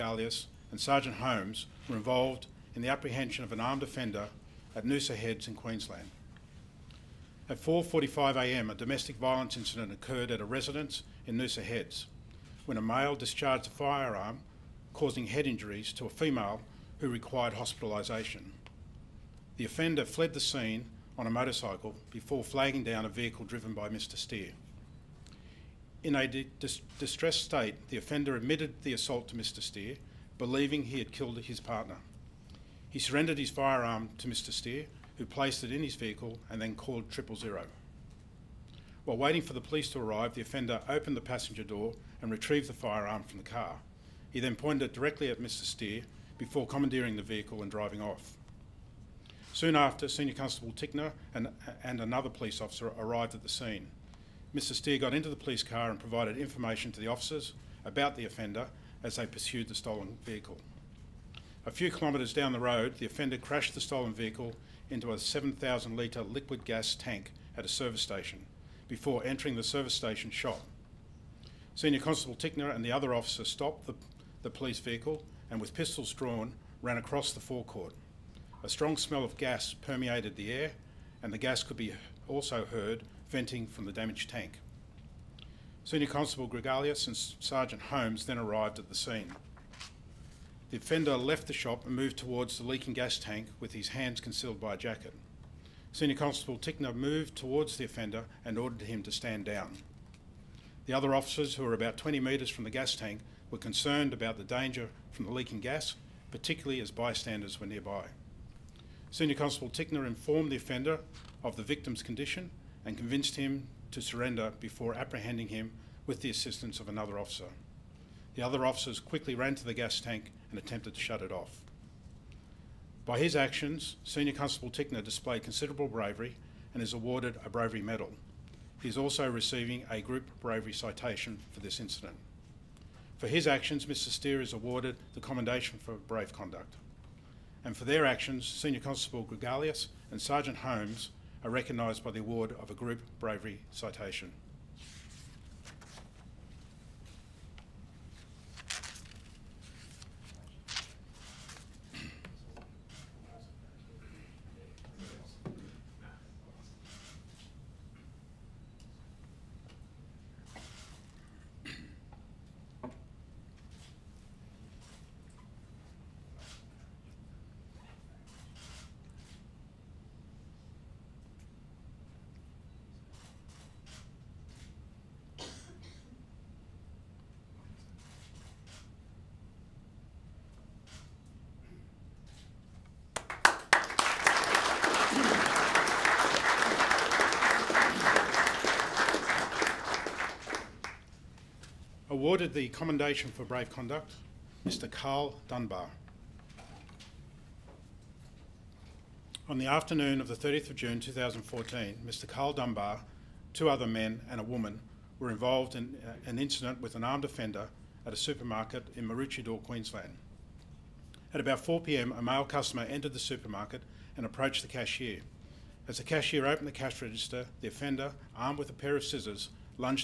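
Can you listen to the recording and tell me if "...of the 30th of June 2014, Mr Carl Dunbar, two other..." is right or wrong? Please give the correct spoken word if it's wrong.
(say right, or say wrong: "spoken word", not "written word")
right.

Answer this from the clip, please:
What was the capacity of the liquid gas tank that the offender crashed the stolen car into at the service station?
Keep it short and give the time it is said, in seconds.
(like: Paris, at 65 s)
7,000 litres, at 65 s.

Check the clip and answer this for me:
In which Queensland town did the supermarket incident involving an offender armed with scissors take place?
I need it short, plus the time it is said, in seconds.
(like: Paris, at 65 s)
Maroochydore, at 209 s.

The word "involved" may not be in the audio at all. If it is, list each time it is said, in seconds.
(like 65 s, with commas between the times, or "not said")
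1 s, 205 s.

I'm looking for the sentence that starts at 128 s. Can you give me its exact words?
He is also receiving a group bravery citation for this incident.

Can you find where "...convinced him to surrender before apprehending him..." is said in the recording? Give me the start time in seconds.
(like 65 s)
112 s.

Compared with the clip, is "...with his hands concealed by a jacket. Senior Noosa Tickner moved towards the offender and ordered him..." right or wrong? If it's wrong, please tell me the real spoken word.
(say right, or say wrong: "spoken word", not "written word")
wrong: "Constable", not "Noosa".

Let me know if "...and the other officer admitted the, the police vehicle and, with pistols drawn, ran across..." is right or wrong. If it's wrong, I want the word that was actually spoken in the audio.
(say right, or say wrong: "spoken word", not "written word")
wrong: "stopped", not "admitted".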